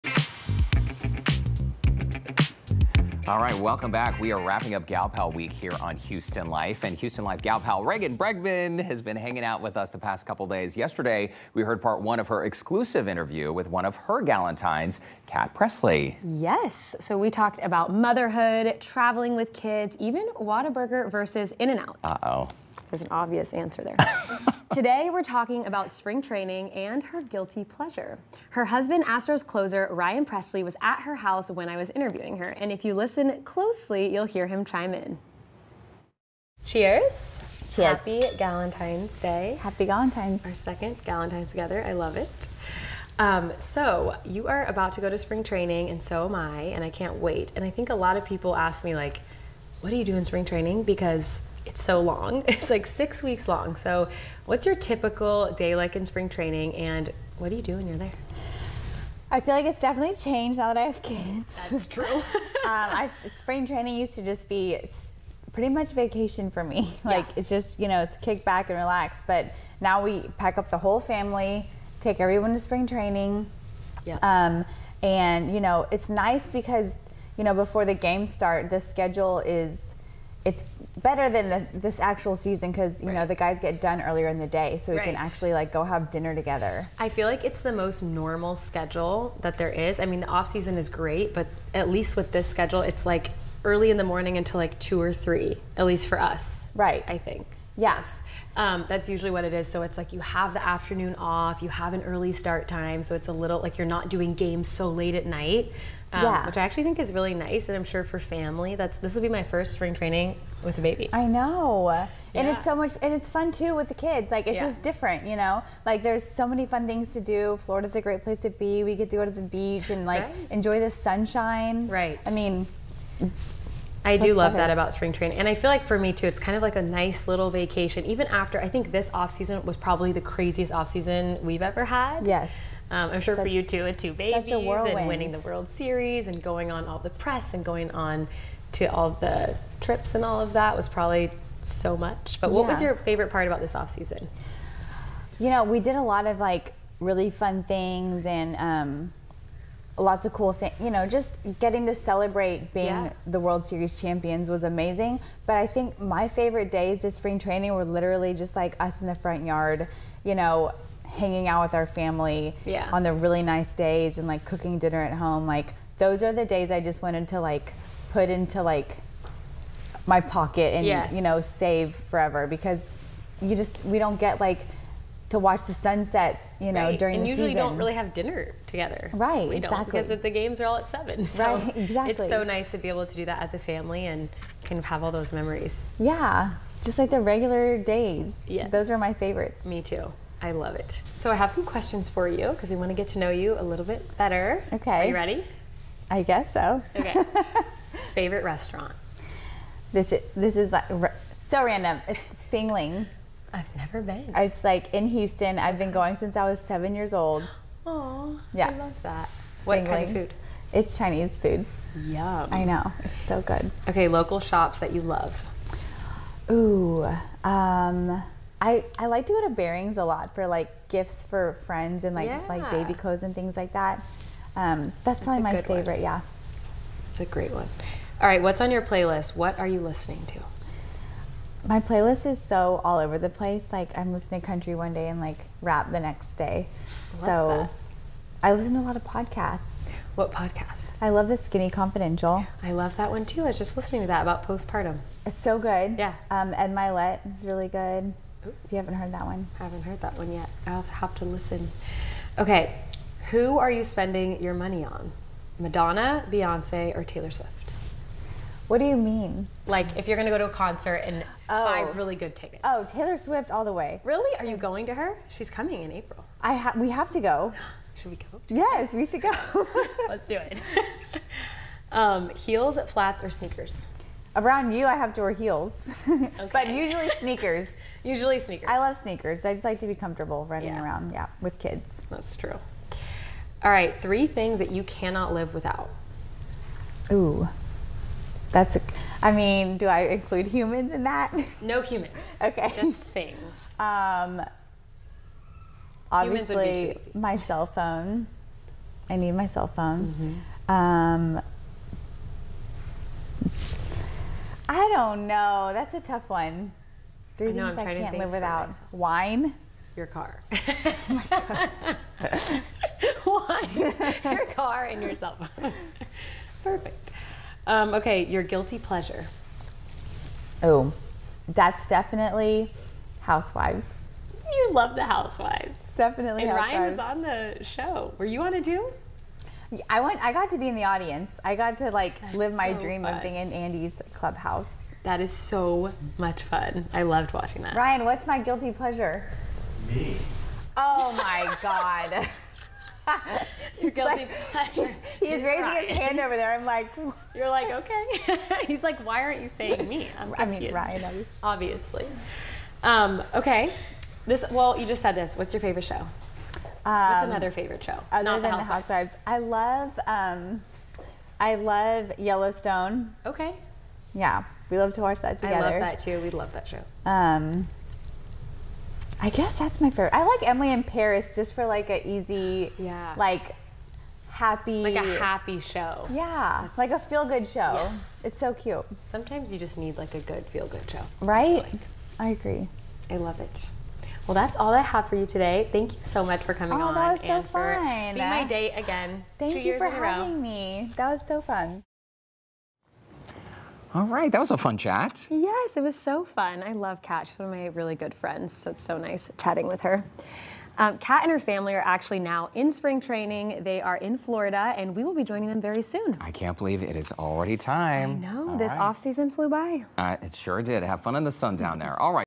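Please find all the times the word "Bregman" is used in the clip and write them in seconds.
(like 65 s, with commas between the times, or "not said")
8 s.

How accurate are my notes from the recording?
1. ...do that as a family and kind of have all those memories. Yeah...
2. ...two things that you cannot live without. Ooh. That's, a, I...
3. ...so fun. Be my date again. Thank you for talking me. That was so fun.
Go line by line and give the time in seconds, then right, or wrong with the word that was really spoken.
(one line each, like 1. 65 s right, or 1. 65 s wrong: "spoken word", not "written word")
1. 183 s right
2. 284 s wrong: "three", not "two"
3. 387 s wrong: "having", not "talking".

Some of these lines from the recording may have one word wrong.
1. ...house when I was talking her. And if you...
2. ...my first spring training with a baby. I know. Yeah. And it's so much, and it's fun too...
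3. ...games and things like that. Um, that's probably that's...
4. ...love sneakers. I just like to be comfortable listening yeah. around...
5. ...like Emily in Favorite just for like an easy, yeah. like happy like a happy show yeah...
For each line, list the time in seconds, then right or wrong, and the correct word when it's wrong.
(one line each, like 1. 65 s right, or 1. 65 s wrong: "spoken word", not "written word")
1. 31 s wrong: "interviewing", not "talking"
2. 109 s right
3. 222 s wrong: "clothes", not "games"
4. 278 s wrong: "running", not "listening"
5. 370 s wrong: "Paris", not "Favorite".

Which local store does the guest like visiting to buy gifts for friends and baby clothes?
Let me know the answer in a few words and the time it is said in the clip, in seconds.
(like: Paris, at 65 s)
Bering's, at 219 s.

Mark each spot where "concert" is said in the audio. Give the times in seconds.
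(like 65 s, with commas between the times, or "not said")
260 s.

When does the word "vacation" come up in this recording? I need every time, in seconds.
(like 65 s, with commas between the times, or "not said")
65 s, 127 s.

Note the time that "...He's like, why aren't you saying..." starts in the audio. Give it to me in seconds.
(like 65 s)
348 s.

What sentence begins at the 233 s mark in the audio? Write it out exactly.
Like I'm listening to country one day and like rap the next day.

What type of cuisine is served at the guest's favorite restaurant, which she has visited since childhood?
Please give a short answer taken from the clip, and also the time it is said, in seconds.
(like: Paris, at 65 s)
Chinese food, at 210 s.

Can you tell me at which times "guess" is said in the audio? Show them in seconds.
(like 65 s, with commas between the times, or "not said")
196 s, 369 s.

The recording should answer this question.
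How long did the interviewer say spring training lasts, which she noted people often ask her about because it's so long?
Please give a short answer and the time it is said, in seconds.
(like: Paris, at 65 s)
6 weeks, at 52 s.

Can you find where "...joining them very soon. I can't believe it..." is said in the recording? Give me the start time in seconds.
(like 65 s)
405 s.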